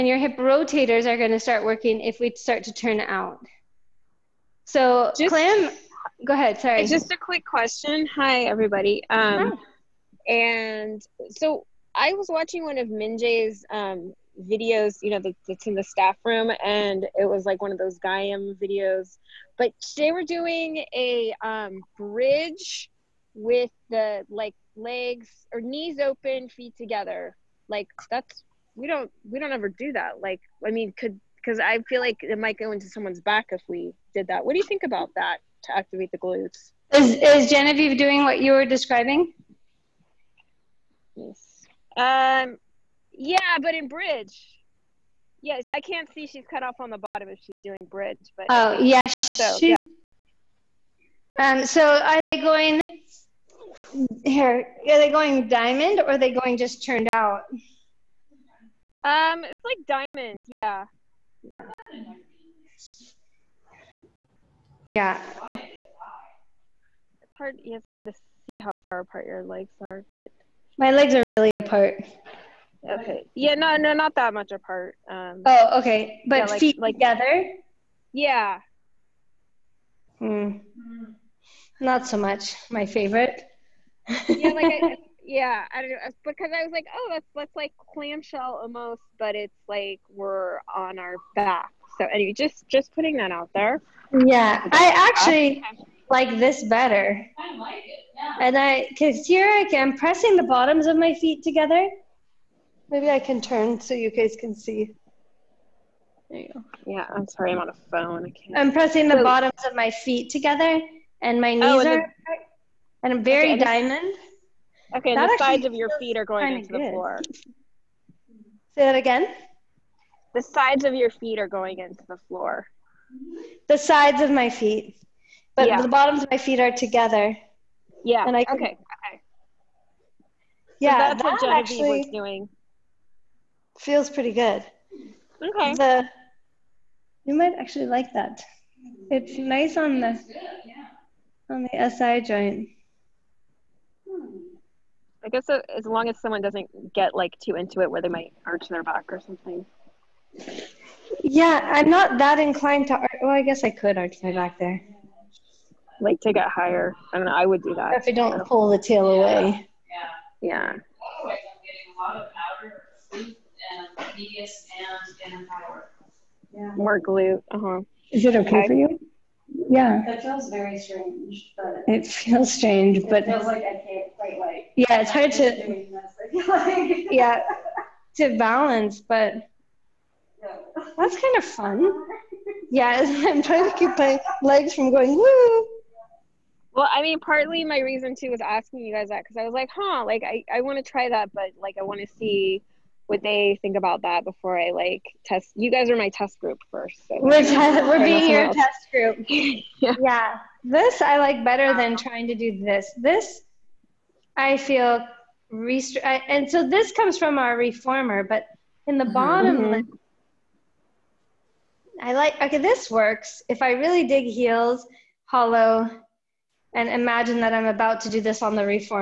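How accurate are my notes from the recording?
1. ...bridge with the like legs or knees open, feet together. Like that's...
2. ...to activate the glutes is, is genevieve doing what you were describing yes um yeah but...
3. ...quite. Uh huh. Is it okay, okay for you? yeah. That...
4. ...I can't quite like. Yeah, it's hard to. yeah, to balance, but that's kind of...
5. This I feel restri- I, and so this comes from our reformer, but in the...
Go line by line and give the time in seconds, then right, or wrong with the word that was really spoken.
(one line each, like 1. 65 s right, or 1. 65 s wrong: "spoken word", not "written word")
1. 21 s right
2. 35 s right
3. 167 s wrong: "glute", not "quite"
4. 173 s right
5. 202 s right.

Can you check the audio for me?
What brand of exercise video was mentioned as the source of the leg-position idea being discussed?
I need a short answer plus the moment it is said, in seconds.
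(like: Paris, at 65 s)
Gaiam, at 17 s.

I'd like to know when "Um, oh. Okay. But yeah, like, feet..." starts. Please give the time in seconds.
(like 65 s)
75 s.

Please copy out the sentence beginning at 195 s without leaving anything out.
You guys are my test group first.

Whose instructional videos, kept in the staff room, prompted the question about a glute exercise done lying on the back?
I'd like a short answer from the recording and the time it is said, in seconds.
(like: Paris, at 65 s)
Minjay, at 12 s.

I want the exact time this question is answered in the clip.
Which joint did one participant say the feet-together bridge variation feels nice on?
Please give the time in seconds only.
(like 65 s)
141 s.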